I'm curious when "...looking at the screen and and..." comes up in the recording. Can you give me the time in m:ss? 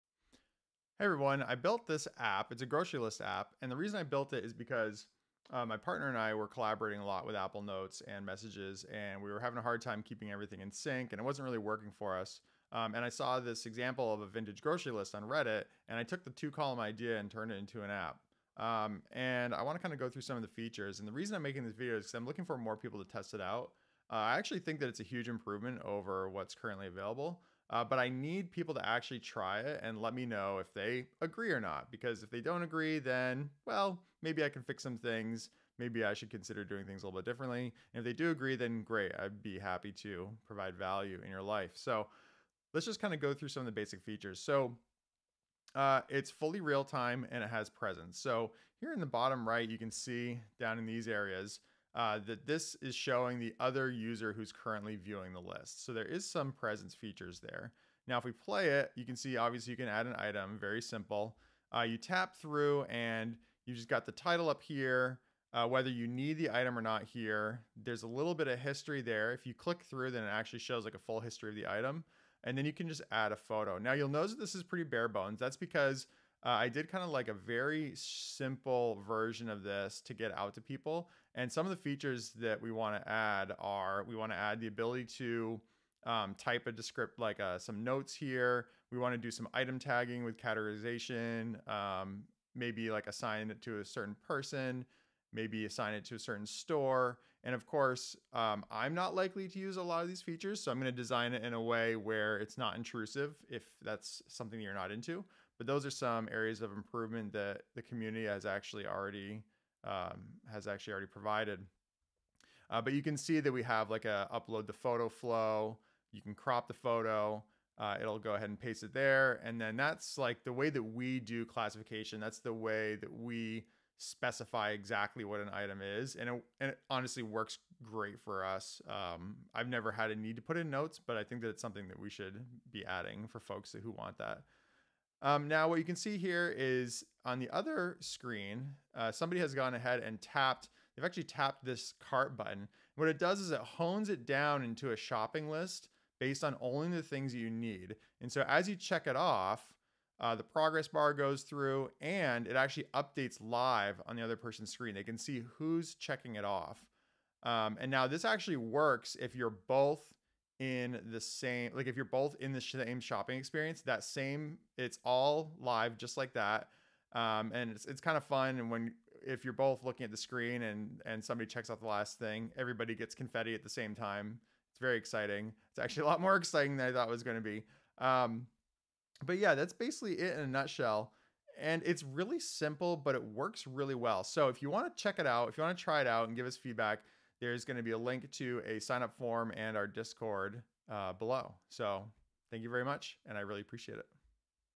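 2:49.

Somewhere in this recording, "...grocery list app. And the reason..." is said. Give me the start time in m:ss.
0:02.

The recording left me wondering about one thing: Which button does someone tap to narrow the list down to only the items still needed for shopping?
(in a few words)
cart button.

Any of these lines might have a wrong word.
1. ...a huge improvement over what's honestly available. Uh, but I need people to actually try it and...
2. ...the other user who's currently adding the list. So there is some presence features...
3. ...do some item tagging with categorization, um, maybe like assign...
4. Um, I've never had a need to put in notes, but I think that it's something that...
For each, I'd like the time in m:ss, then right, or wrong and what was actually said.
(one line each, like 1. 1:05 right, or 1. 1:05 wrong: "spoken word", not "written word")
1. 0:24 wrong: "currently", not "honestly"
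2. 0:53 wrong: "viewing", not "adding"
3. 1:29 right
4. 2:08 right.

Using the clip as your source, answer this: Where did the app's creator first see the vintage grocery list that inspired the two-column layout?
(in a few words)
Reddit.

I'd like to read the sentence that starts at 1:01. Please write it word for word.
Uh, you tap through and you just got the title up here, uh, whether you need the item or not here.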